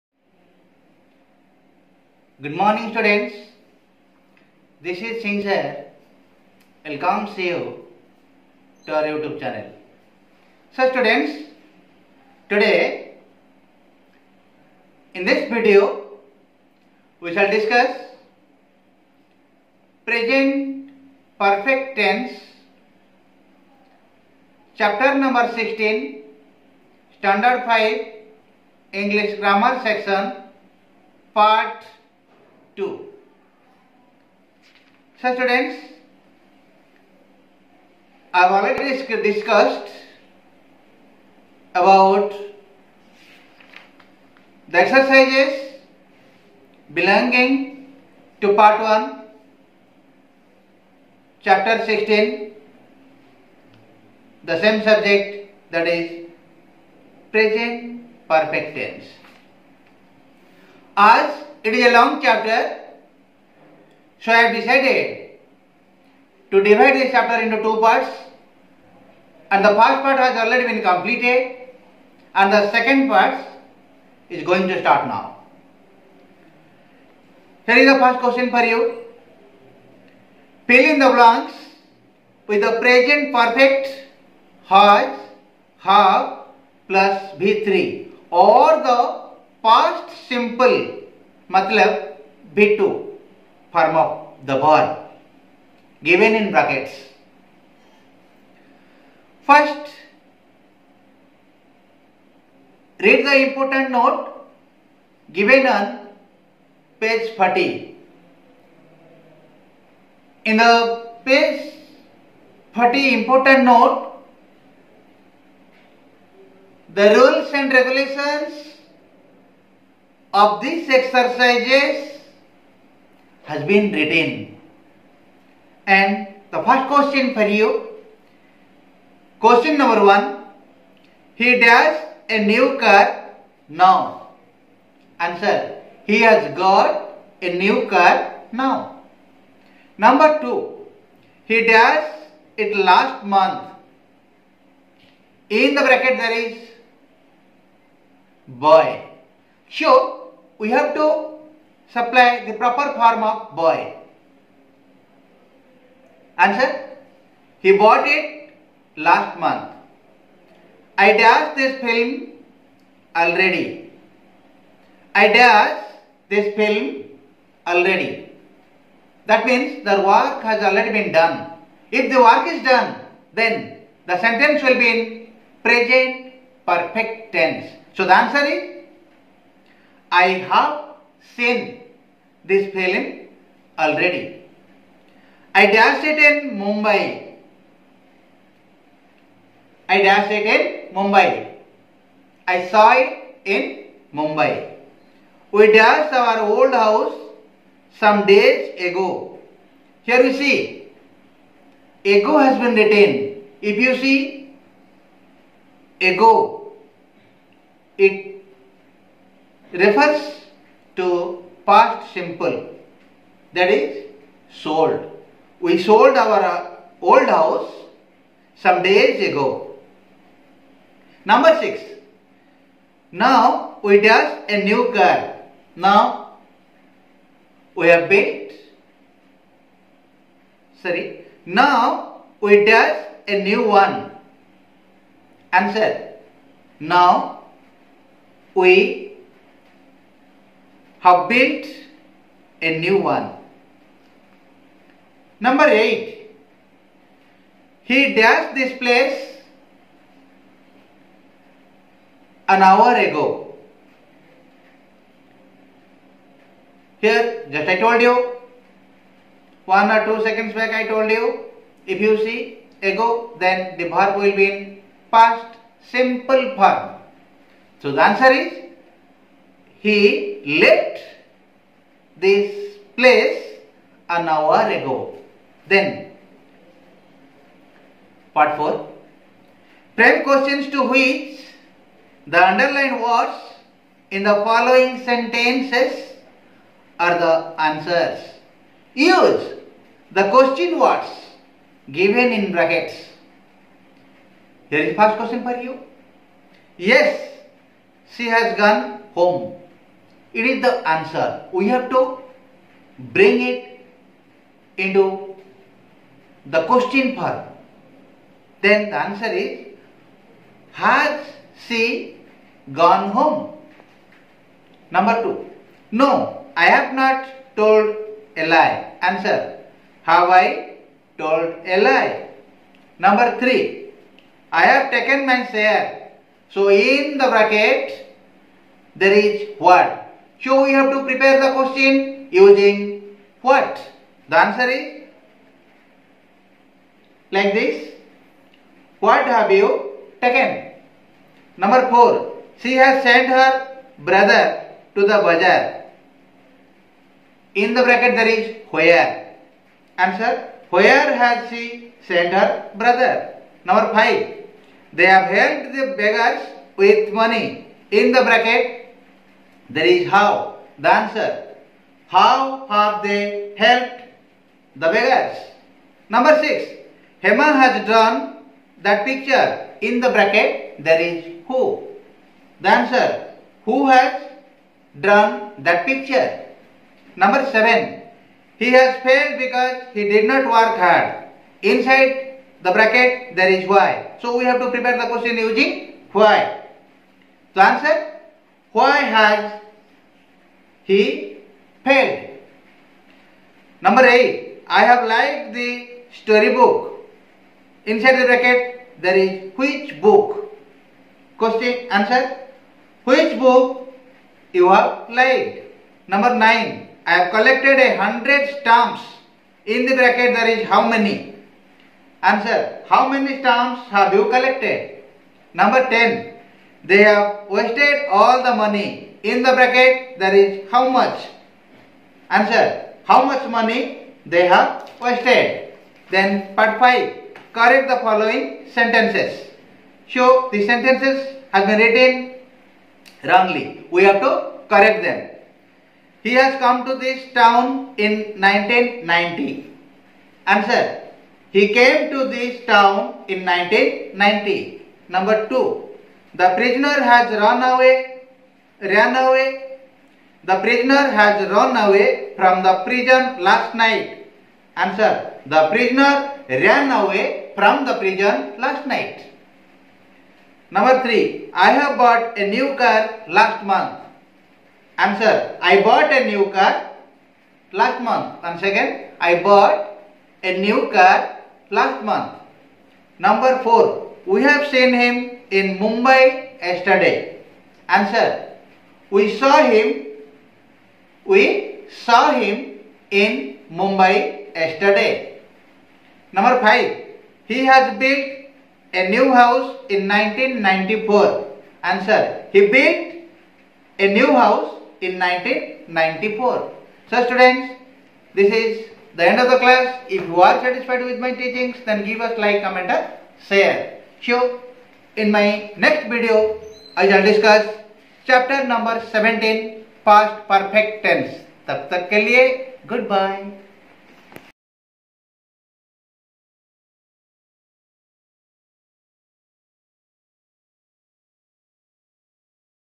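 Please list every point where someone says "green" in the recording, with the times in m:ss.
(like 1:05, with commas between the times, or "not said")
not said.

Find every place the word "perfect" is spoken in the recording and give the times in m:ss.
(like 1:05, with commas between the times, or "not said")
0:21, 0:58, 1:23, 2:56, 8:30.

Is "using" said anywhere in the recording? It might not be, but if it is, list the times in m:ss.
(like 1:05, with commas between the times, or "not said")
5:32, 6:25.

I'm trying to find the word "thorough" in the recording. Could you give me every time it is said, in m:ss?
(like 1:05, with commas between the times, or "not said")
not said.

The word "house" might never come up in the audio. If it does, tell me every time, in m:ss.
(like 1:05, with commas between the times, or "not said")
3:16, 3:37, 8:09, 8:14.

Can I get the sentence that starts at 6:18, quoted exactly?
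He has failed because he did not work hard.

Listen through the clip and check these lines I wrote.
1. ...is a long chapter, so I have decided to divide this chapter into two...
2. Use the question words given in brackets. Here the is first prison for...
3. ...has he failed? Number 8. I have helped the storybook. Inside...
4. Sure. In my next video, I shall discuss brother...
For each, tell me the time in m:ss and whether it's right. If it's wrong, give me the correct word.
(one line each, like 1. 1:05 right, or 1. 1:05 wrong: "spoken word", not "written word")
1. 1:01 right
2. 4:48 wrong: "question", not "prison"
3. 6:29 wrong: "liked", not "helped"
4. 8:24 wrong: "chapter", not "brother".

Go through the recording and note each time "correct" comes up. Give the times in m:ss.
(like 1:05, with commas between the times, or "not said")
7:07, 7:14.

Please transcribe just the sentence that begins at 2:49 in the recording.
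That means the work has already been done.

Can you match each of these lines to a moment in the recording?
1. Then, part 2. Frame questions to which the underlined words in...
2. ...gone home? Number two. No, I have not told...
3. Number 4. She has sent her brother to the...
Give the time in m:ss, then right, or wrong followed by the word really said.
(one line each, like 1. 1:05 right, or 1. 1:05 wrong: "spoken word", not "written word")
1. 4:35 wrong: "4", not "2"
2. 5:12 right
3. 5:41 right.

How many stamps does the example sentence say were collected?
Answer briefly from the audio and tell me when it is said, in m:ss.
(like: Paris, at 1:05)
100, at 6:47.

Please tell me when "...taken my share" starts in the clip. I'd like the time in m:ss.
5:24.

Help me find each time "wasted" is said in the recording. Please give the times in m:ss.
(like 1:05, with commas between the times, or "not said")
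6:57, 7:04.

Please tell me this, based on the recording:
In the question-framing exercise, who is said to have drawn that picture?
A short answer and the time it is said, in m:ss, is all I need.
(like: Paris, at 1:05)
Hema, at 6:07.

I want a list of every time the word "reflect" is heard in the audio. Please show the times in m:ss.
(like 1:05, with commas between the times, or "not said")
not said.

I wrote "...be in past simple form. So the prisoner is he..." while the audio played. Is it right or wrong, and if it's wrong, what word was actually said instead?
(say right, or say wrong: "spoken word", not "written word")
wrong: "answer", not "prisoner".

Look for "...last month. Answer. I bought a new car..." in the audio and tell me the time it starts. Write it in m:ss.
7:43.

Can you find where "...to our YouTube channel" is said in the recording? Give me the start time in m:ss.
0:08.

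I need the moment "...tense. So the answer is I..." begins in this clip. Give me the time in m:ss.
2:57.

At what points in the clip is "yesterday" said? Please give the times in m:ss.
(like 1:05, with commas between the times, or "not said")
7:56, 8:04.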